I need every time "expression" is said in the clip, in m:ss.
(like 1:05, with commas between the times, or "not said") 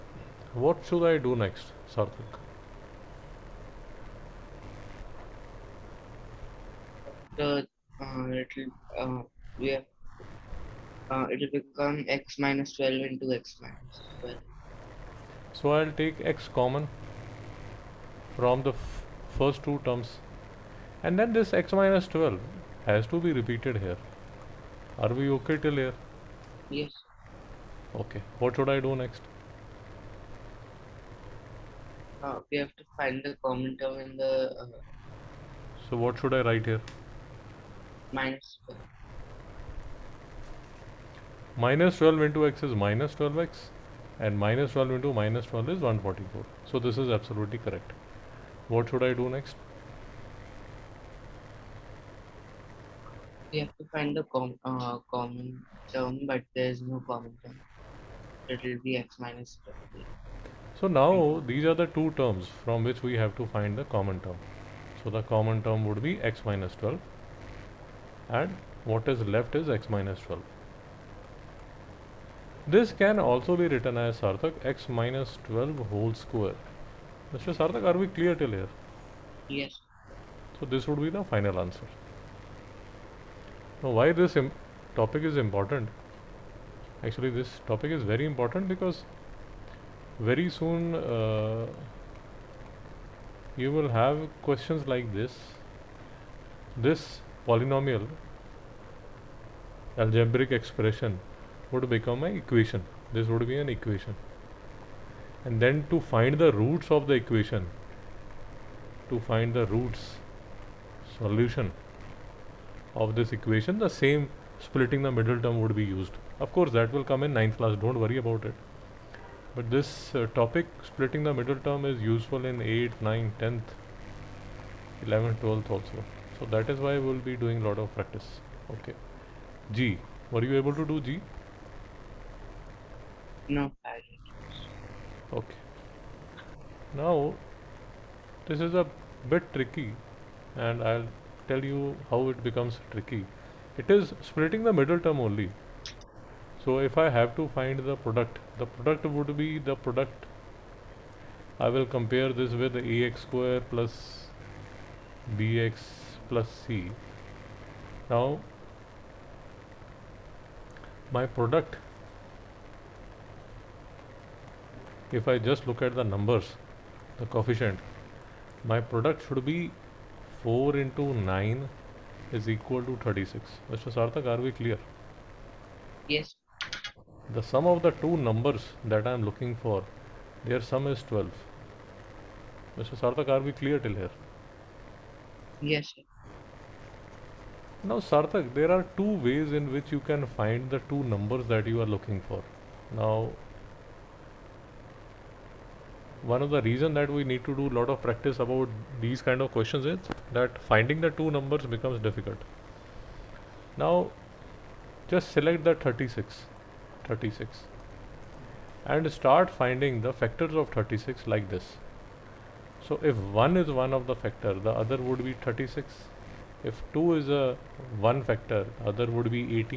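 1:40.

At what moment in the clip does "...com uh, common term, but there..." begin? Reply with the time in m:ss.
0:54.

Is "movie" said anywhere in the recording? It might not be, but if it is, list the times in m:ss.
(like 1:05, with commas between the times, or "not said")
not said.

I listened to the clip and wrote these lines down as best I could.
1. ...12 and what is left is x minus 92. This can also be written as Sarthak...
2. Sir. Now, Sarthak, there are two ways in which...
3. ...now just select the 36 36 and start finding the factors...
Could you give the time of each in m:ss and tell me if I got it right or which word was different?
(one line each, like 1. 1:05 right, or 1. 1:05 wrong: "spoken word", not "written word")
1. 1:06 wrong: "12", not "92"
2. 3:05 right
3. 3:23 right.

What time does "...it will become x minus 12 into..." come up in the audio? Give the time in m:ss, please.
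0:11.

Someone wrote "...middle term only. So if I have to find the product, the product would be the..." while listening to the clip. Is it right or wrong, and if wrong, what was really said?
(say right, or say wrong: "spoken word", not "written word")
right.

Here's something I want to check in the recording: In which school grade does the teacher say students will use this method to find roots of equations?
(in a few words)
ninth class.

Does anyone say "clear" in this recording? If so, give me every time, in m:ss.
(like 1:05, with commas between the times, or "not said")
1:18, 2:54, 3:03.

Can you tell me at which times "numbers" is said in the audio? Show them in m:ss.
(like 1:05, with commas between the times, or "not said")
2:46, 2:58, 3:11, 3:21.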